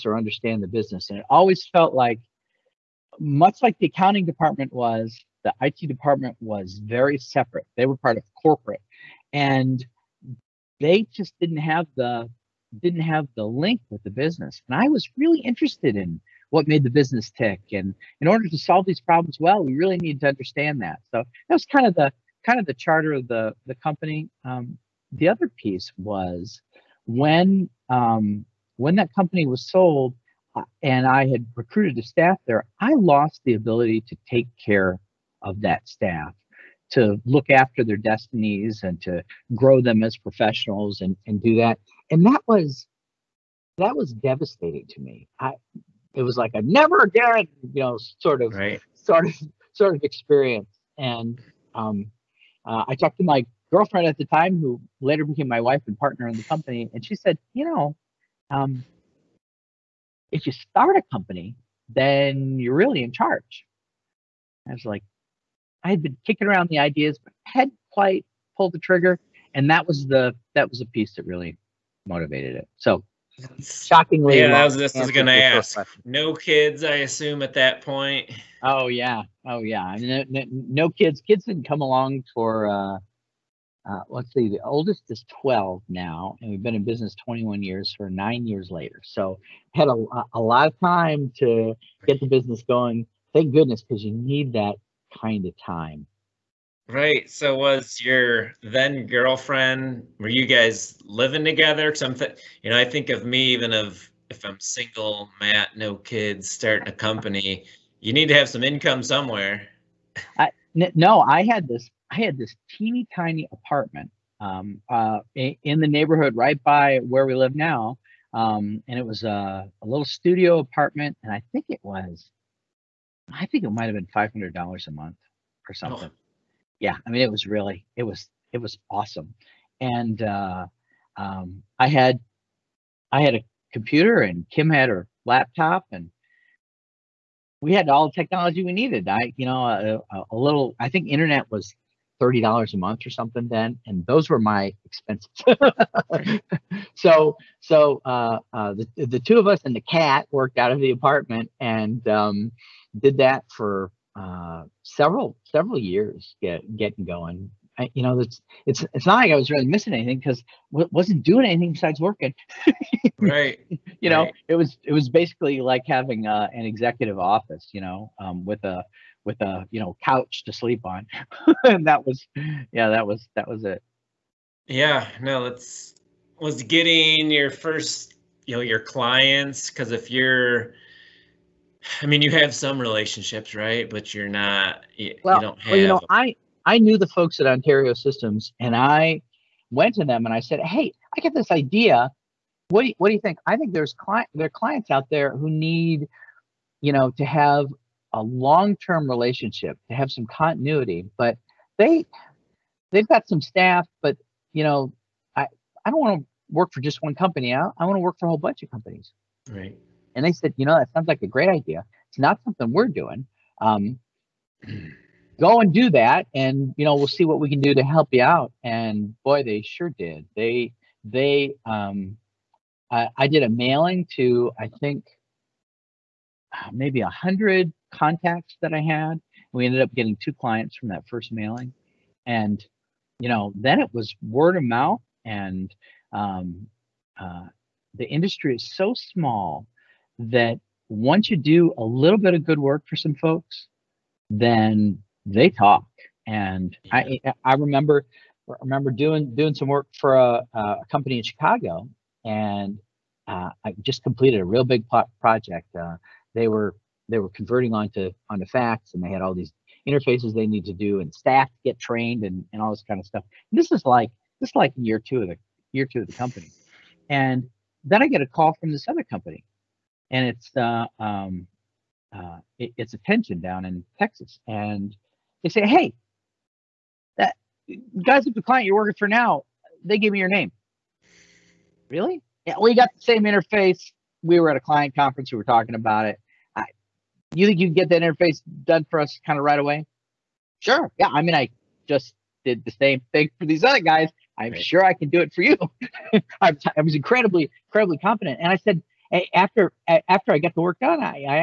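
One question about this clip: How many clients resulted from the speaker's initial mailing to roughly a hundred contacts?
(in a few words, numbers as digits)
2.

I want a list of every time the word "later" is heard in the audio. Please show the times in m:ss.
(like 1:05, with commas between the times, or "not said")
0:55, 1:28.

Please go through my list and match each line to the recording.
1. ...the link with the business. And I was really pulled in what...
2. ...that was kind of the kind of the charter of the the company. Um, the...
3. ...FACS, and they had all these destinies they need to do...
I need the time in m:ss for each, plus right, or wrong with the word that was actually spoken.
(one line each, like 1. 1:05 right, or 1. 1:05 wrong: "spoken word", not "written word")
1. 0:13 wrong: "interested", not "pulled"
2. 0:21 right
3. 4:18 wrong: "interfaces", not "destinies".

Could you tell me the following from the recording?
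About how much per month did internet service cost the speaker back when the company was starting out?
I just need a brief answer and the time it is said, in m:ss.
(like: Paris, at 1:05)
$30, at 2:22.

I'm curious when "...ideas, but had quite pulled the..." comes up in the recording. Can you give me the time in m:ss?
1:06.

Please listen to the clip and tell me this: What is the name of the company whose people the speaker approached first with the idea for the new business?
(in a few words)
Ontario Systems.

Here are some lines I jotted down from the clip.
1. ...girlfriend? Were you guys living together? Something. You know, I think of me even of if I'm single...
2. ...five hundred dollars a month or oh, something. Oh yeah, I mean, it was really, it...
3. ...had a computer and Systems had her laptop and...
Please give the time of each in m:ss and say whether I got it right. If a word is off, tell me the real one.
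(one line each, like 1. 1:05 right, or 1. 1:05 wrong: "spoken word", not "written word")
1. 1:39 right
2. 2:04 right
3. 2:13 wrong: "Kim", not "Systems".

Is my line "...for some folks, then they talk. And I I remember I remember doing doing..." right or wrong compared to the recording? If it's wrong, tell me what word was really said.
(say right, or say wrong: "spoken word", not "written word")
right.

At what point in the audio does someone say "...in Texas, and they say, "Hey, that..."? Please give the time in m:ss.
4:33.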